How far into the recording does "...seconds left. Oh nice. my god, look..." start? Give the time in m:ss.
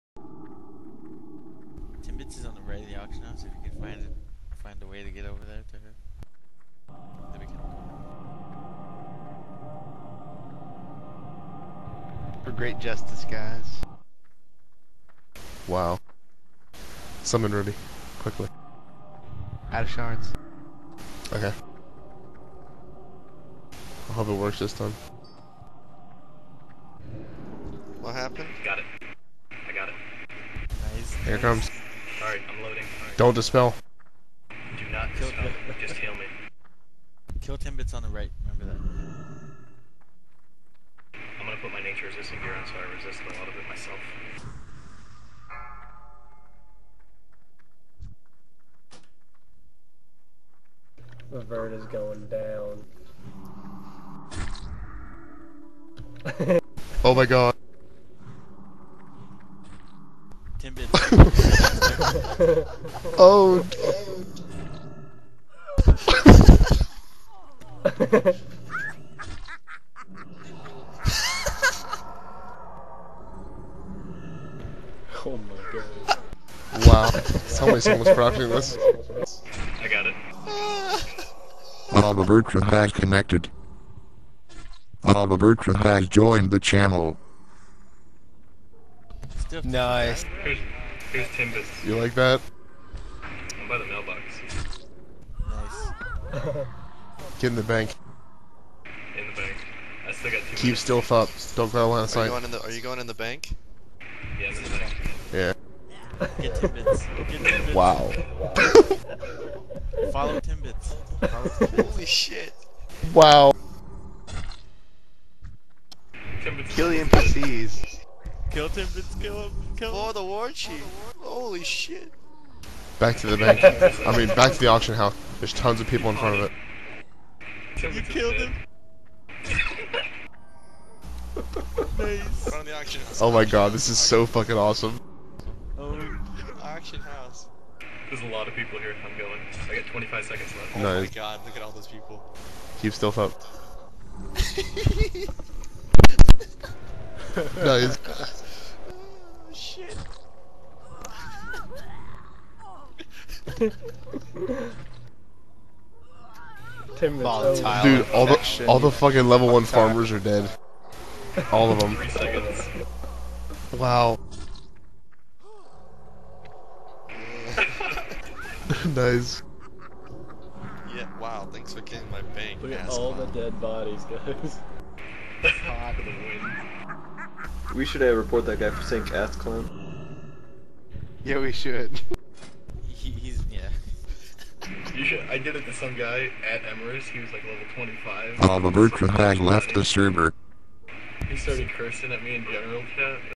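2:20.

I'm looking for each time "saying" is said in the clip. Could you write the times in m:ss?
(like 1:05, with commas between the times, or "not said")
2:58.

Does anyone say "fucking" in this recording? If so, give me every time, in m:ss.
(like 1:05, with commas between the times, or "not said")
2:14, 2:38.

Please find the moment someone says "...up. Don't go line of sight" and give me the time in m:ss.
1:41.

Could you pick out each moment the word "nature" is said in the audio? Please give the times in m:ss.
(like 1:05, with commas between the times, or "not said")
0:41.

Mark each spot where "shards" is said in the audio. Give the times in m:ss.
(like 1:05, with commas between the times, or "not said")
0:19.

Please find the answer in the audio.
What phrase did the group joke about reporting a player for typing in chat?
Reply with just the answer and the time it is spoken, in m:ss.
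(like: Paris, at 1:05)
ass clown, at 2:59.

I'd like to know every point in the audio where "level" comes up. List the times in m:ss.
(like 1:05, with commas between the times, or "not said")
2:39, 3:07.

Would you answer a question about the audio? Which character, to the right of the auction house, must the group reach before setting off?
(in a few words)
Mitz.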